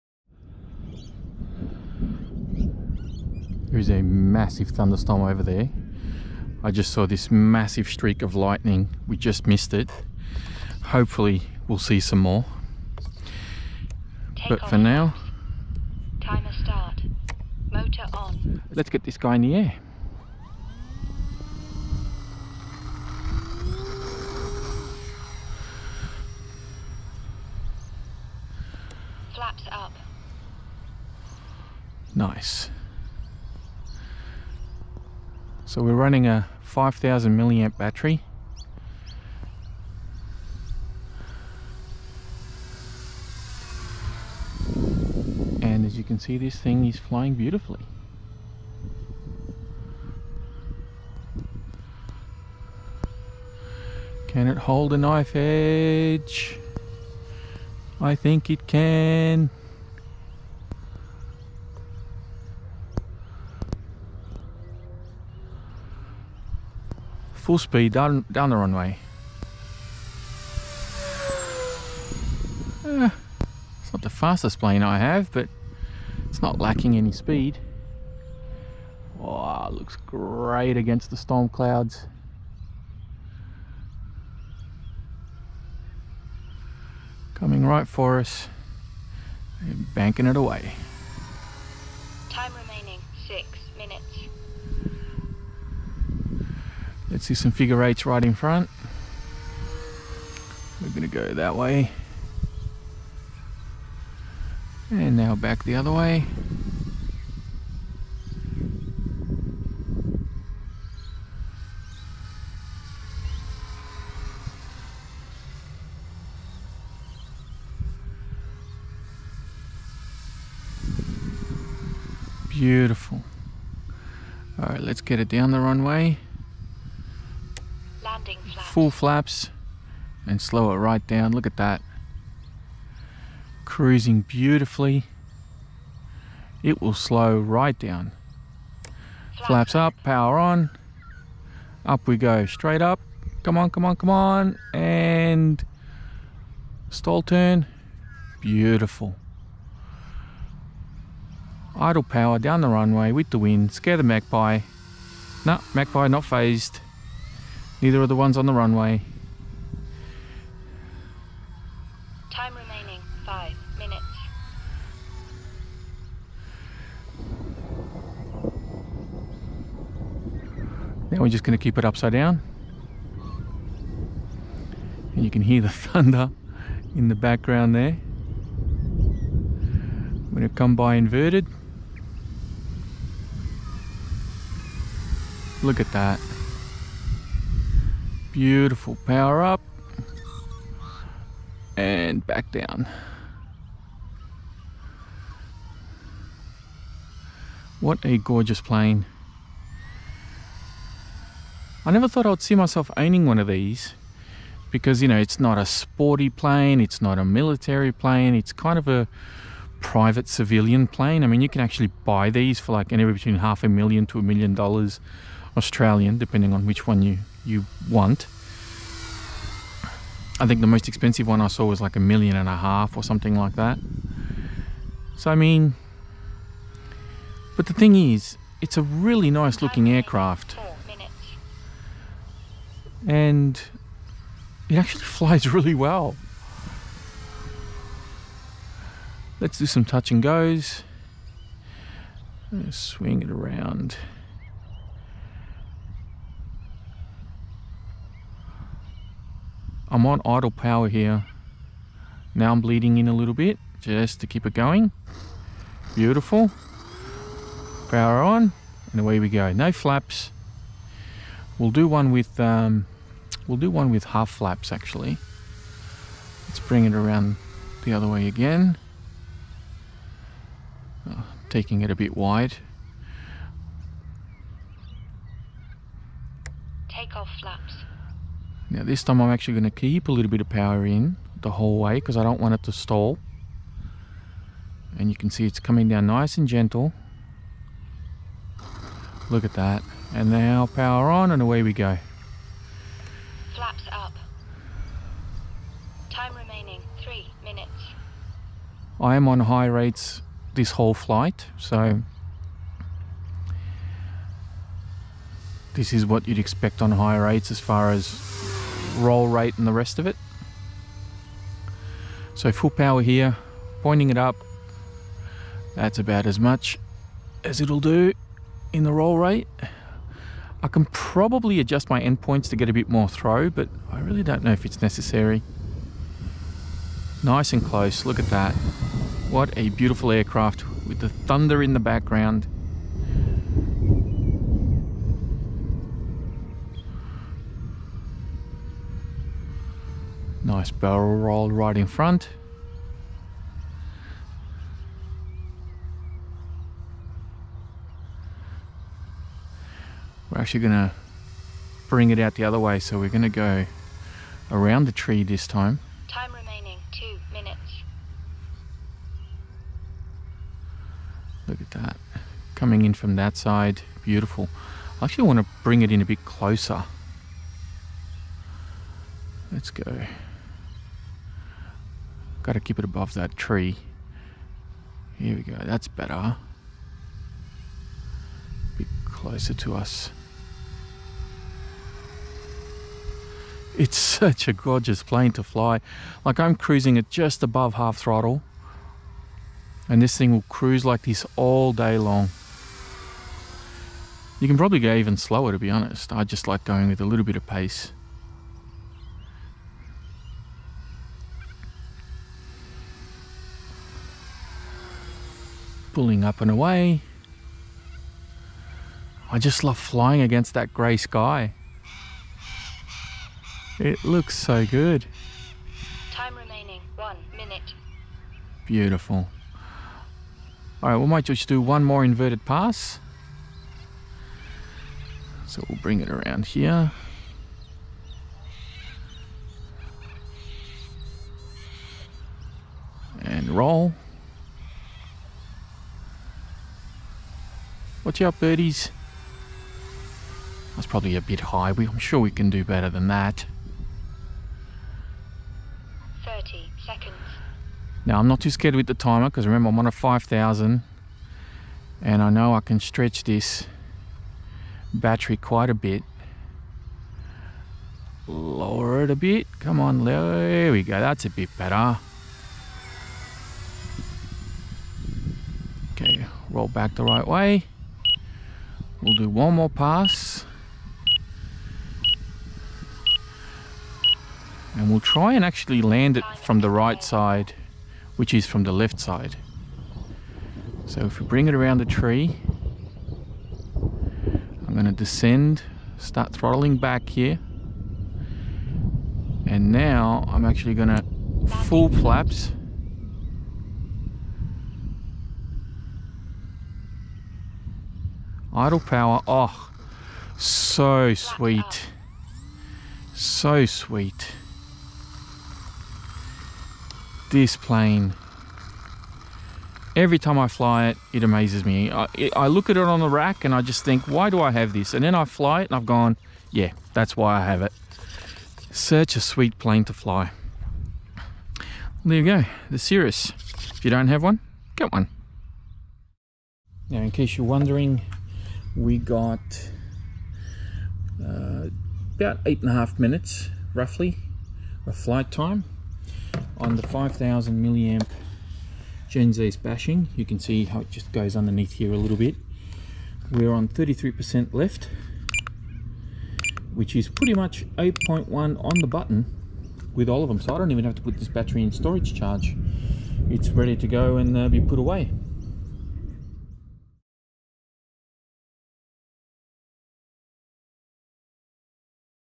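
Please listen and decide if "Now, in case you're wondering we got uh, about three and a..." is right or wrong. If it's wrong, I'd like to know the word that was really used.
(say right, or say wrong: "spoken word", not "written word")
wrong: "eight", not "three".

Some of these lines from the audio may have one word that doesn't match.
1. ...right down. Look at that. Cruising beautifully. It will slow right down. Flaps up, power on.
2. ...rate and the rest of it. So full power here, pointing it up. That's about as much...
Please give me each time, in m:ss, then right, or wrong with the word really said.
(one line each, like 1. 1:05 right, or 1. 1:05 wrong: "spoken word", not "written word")
1. 2:10 right
2. 5:09 right.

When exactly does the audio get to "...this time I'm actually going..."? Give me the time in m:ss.
4:38.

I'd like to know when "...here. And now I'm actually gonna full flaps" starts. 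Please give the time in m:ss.
8:07.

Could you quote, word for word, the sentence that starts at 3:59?
Let's do some touch and goes.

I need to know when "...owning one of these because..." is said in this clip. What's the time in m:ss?
3:22.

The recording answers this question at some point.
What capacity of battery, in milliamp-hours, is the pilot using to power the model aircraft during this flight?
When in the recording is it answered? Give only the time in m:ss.
0:36.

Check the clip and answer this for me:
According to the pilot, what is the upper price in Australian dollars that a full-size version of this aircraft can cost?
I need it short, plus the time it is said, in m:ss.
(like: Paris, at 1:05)
a million dollars, at 3:34.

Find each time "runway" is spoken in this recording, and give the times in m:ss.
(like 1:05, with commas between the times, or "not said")
1:08, 2:05, 2:32, 2:38.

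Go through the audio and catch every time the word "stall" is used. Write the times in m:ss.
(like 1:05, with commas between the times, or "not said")
2:26, 4:42.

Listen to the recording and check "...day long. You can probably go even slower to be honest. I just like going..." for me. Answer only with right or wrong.
right.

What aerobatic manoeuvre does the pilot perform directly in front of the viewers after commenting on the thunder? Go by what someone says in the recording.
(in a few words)
barrel roll.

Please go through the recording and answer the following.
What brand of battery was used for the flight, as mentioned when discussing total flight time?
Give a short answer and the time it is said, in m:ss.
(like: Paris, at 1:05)
Gens Ace, at 8:59.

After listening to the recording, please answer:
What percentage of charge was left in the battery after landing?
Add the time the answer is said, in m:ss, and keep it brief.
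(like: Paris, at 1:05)
33%, at 9:03.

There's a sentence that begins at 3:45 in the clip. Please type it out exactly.
So I mean, but the thing is, it's a really nice looking aircraft.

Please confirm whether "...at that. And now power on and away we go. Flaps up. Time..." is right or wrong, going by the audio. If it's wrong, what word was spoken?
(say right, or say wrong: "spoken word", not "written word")
right.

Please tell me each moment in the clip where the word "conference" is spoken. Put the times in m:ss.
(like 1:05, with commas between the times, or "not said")
not said.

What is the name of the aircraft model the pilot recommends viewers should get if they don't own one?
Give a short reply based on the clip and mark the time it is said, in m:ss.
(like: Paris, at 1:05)
Cirrus, at 8:42.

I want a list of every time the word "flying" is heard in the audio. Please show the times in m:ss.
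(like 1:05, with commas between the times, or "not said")
0:46, 6:49.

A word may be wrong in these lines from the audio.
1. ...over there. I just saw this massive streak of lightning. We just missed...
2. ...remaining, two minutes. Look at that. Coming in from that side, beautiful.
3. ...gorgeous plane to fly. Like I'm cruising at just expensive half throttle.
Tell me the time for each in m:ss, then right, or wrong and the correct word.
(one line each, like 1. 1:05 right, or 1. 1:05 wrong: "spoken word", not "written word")
1. 0:05 right
2. 5:56 right
3. 6:24 wrong: "above", not "expensive".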